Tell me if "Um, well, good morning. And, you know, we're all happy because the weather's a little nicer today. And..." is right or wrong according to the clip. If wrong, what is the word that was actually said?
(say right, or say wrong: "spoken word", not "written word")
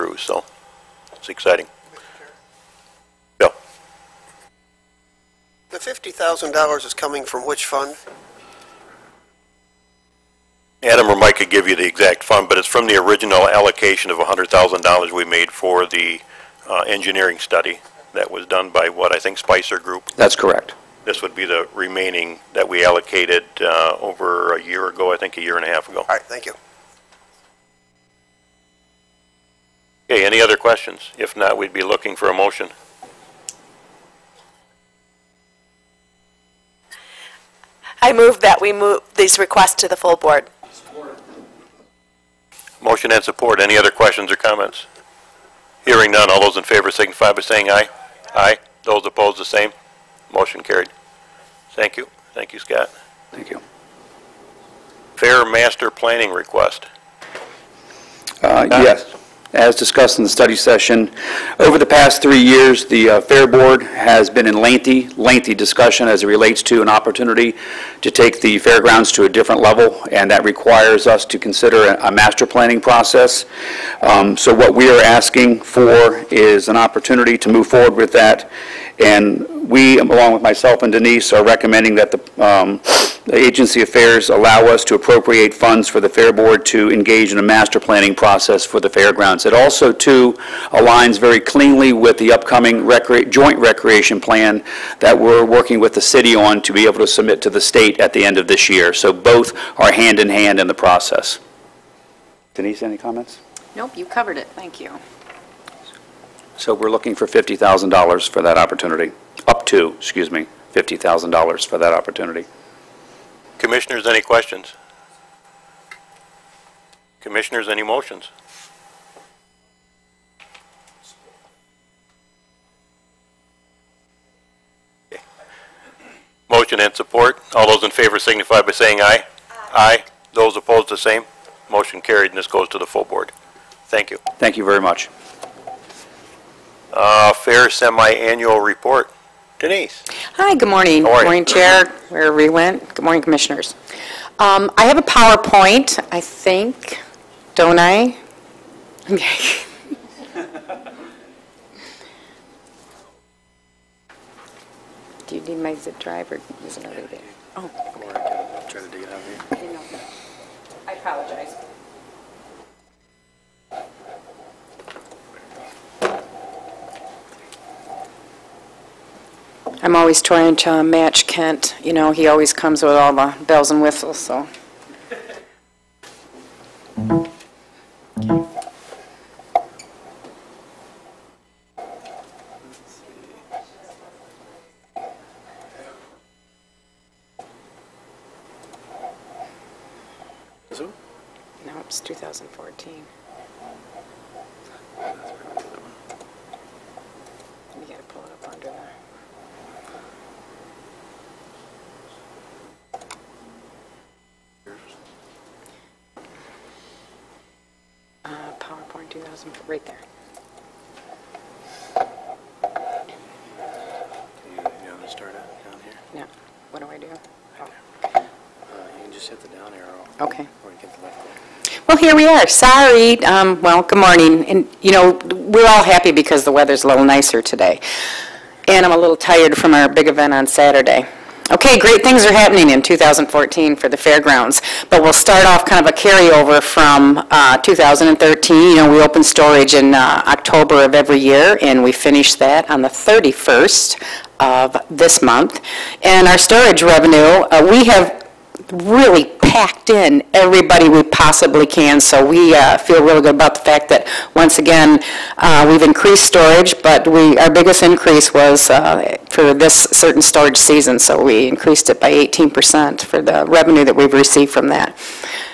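right.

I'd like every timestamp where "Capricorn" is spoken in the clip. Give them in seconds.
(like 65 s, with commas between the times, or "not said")
not said.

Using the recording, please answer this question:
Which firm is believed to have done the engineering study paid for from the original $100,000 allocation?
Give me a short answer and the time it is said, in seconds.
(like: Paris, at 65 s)
Spicer Group, at 19 s.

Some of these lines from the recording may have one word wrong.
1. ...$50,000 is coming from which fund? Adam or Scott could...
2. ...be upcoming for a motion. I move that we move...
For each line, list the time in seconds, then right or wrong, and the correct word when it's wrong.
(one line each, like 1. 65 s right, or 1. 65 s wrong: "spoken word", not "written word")
1. 5 s wrong: "Mike", not "Scott"
2. 31 s wrong: "looking", not "upcoming".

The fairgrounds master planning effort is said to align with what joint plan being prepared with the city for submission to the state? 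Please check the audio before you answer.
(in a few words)
joint recreation plan.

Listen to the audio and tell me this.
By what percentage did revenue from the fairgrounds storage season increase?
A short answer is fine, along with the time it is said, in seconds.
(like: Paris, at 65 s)
18%, at 262 s.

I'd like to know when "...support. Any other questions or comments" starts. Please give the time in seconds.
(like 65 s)
43 s.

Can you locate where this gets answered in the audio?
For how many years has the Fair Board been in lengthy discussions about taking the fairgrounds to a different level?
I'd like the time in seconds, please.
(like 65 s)
62 s.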